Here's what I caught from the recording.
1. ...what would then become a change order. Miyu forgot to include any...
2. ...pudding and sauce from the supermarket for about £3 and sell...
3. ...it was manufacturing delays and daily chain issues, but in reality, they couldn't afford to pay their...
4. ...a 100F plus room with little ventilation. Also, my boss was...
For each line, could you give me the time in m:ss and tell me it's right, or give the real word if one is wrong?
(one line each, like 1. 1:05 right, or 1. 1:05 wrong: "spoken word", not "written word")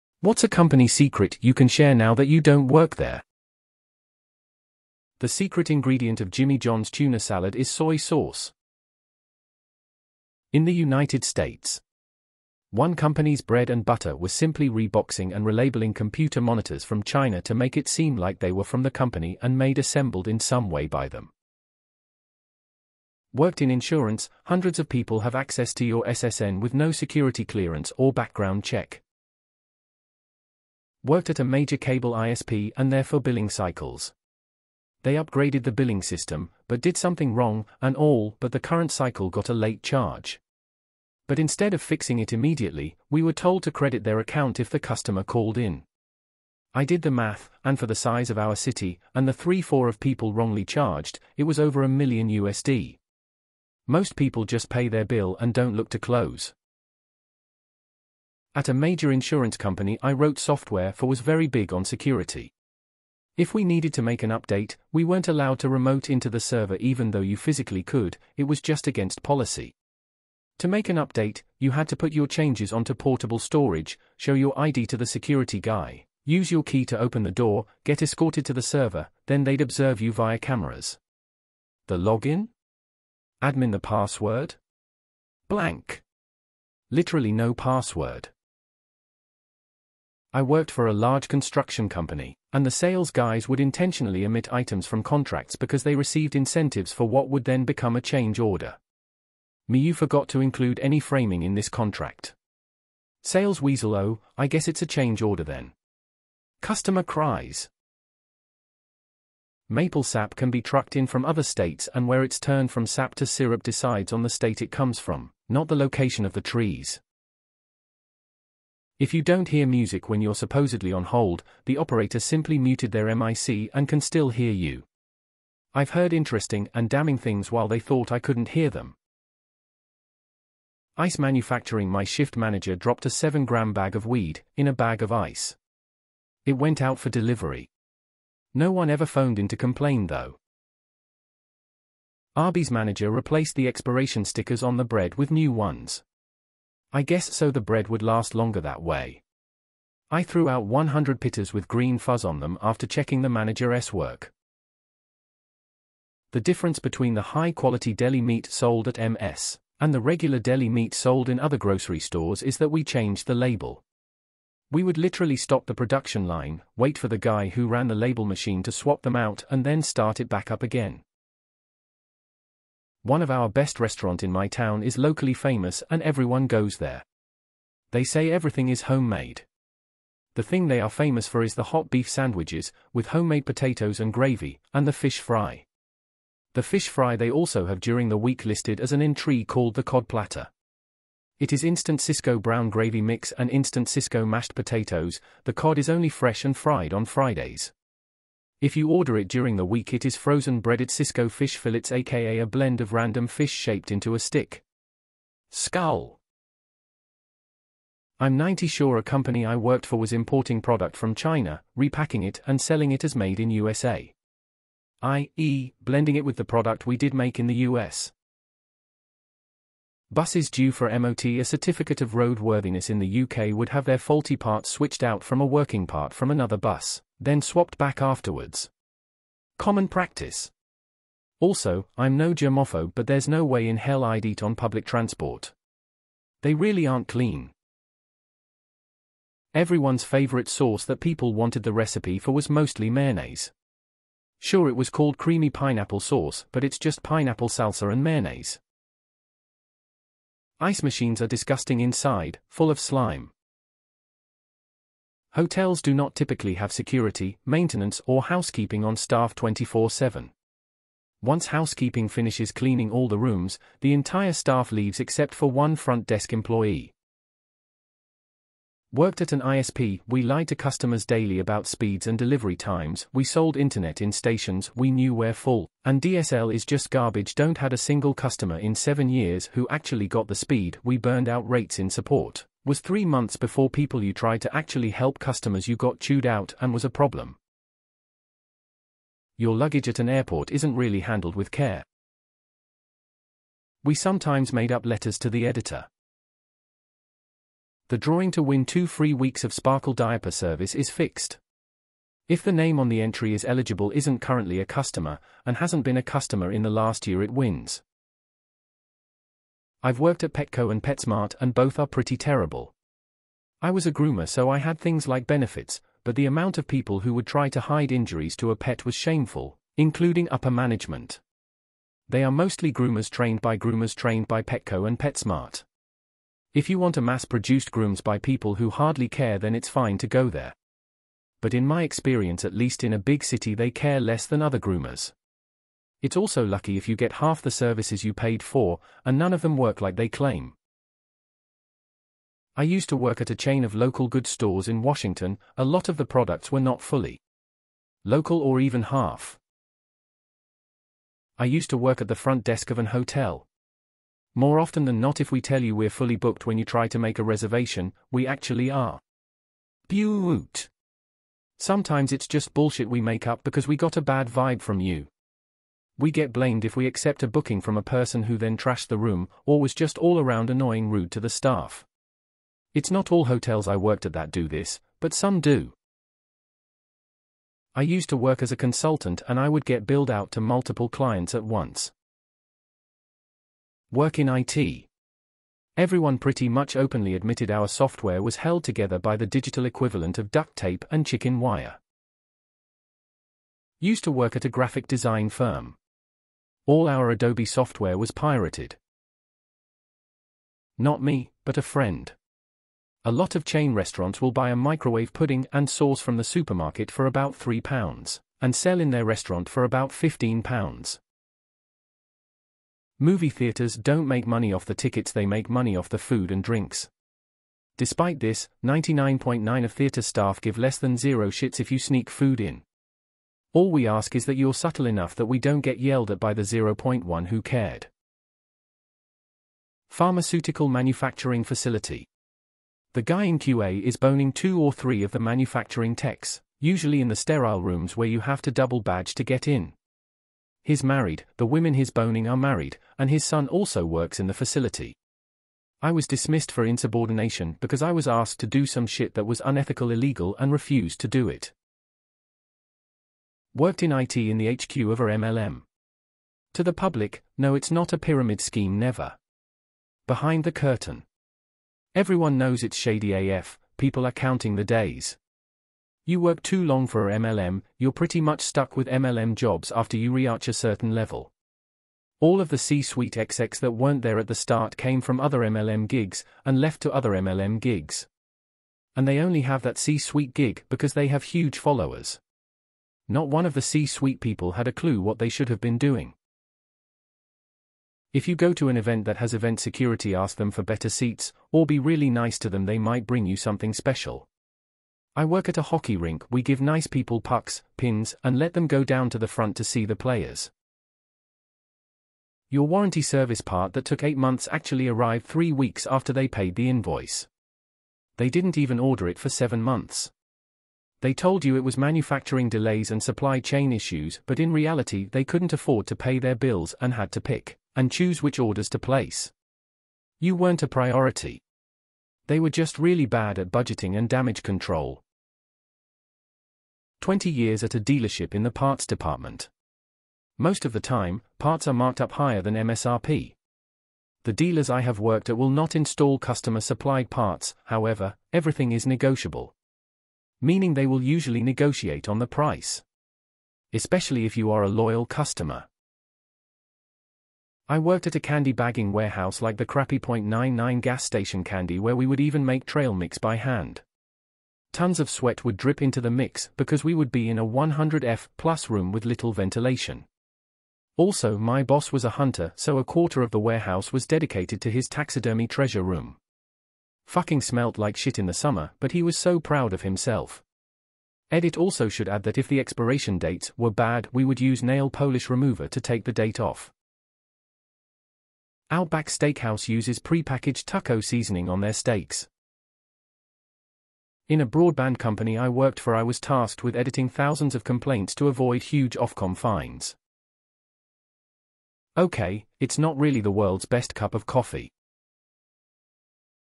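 1. 1:37 right
2. 6:45 right
3. 8:31 wrong: "supply", not "daily"
4. 9:17 right.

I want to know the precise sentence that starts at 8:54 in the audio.
The dealers I have worked at will not install customer supplied parts, however, everything is negotiable.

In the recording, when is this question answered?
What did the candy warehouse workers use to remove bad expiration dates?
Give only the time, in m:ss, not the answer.
9:34.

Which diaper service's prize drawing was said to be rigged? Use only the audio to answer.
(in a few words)
Sparkle.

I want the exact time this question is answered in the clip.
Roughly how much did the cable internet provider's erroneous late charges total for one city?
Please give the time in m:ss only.
0:51.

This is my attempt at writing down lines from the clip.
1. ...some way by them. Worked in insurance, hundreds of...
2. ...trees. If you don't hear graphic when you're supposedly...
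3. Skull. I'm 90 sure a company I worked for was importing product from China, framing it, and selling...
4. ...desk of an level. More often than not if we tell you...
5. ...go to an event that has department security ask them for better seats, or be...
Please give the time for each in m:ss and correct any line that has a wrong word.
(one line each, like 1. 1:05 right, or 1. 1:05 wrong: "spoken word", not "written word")
1. 0:20 right
2. 1:56 wrong: "music", not "graphic"
3. 3:25 wrong: "repacking", not "framing"
4. 5:52 wrong: "hotel", not "level"
5. 8:08 wrong: "event", not "department".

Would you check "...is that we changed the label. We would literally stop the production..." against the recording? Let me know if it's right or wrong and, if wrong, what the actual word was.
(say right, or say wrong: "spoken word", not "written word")
right.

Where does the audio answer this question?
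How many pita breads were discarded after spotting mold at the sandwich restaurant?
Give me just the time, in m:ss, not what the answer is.
2:30.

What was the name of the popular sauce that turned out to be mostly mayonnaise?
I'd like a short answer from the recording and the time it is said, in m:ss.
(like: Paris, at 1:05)
Creamy pineapple sauce, at 4:05.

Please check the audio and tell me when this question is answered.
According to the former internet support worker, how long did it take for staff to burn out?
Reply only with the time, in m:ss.
4:42.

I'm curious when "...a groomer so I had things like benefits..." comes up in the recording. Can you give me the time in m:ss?
5:13.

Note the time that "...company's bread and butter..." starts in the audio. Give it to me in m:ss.
0:12.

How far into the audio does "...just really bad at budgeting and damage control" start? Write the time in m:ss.
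8:42.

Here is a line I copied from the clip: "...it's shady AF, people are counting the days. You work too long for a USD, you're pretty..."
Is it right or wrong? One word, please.
wrong.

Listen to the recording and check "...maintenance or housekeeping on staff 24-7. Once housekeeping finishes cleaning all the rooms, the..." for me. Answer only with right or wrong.
right.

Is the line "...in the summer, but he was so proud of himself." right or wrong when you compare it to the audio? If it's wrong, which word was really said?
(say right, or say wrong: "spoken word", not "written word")
right.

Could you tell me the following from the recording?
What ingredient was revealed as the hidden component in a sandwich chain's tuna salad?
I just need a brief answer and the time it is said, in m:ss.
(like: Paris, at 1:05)
Soy sauce, at 0:07.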